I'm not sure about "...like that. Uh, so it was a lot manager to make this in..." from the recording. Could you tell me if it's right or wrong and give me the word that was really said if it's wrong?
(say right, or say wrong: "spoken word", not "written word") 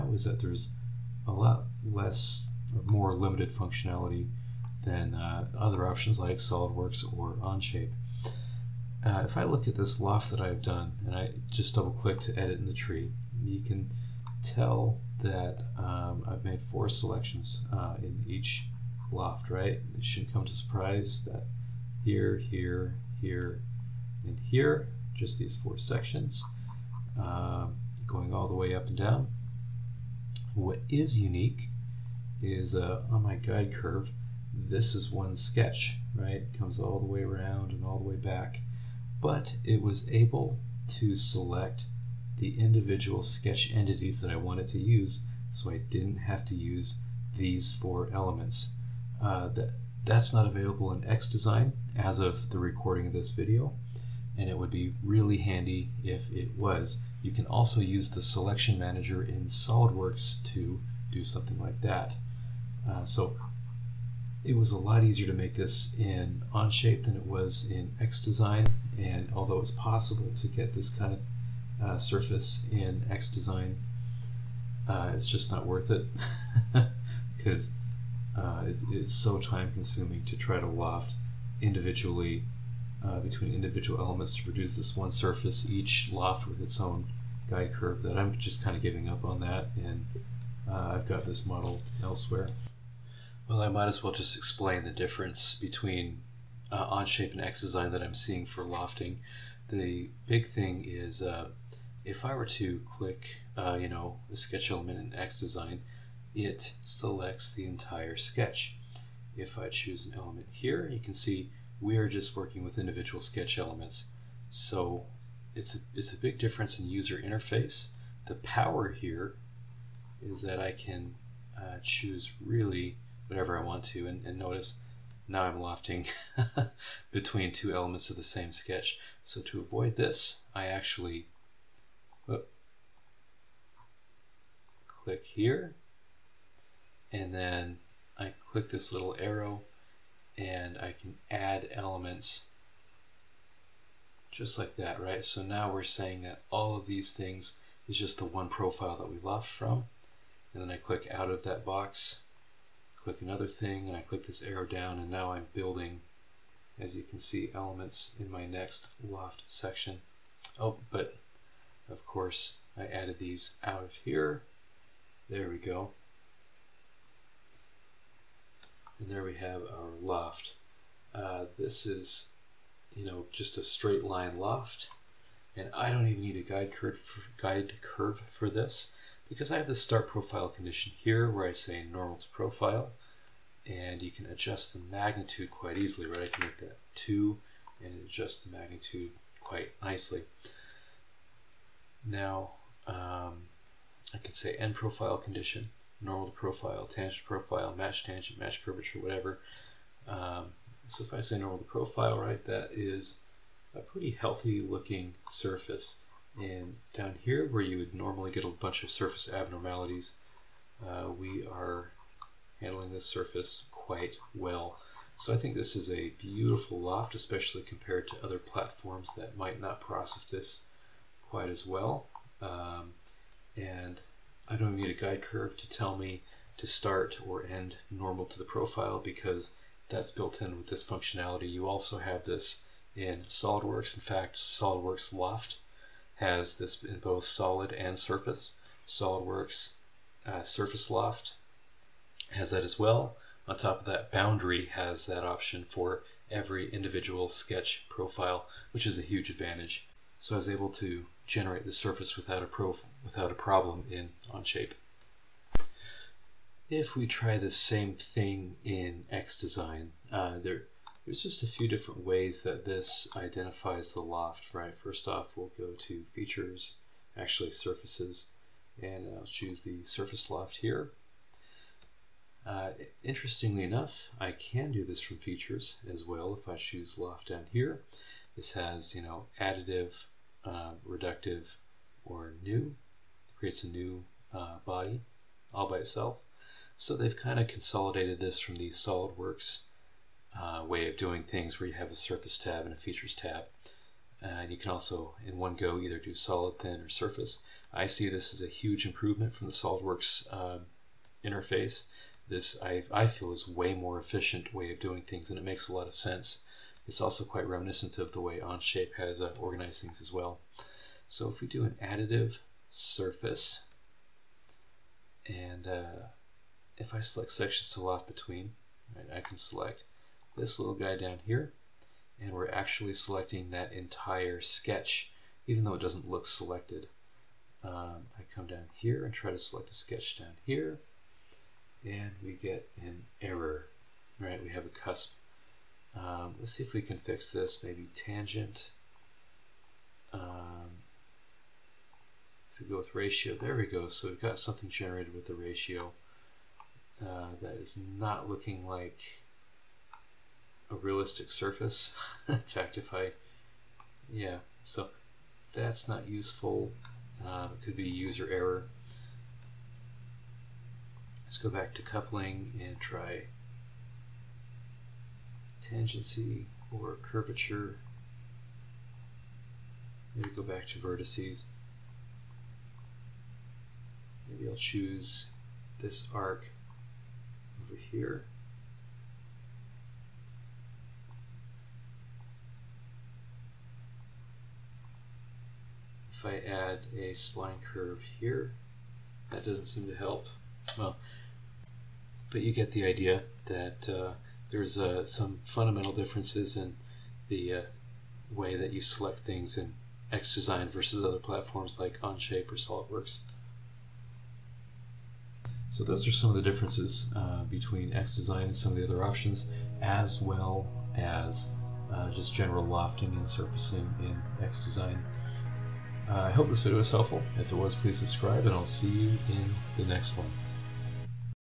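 wrong: "easier", not "manager".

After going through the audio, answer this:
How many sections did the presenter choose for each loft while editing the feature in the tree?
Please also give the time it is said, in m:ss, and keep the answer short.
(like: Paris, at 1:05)
4, at 0:16.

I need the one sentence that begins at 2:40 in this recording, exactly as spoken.
Oh, but of course, I added these out of here.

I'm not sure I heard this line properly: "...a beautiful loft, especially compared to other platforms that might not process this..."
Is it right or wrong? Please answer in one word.
right.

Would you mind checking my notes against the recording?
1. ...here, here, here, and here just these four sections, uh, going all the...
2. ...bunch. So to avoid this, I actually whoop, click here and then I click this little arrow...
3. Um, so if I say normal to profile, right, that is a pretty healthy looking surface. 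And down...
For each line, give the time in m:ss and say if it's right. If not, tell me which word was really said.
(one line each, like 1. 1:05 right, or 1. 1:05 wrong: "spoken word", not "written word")
1. 0:22 right
2. 2:08 wrong: "sketch", not "bunch"
3. 3:20 right.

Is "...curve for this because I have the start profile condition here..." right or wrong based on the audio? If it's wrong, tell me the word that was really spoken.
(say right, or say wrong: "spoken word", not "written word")
right.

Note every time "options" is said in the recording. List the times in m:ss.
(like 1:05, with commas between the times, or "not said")
0:05, 4:05, 6:49.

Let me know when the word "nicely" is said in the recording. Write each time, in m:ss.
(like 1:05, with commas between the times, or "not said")
3:09.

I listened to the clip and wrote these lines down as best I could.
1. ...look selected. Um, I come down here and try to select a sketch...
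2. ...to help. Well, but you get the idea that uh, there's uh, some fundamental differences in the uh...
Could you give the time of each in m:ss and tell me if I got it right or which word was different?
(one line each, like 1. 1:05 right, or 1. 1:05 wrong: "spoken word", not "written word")
1. 5:26 right
2. 6:29 right.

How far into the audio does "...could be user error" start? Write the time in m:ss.
5:57.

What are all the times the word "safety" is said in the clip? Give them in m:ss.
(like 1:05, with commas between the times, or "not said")
not said.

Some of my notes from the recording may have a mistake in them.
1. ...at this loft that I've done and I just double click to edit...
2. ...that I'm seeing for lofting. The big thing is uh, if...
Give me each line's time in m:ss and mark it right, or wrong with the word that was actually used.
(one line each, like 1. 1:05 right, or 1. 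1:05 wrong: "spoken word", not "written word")
1. 0:09 right
2. 1:37 right.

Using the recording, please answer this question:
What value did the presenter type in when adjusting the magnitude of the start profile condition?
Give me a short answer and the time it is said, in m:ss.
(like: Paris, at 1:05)
2, at 3:06.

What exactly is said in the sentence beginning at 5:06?
It's also quite reminiscent of the way Onshape has uh, organized things as well.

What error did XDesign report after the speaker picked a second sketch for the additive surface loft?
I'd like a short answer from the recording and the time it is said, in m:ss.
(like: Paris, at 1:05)
A cusp, at 5:34.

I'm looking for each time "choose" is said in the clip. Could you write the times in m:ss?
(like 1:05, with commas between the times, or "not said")
1:49, 2:01, 4:29, 4:36, 6:14.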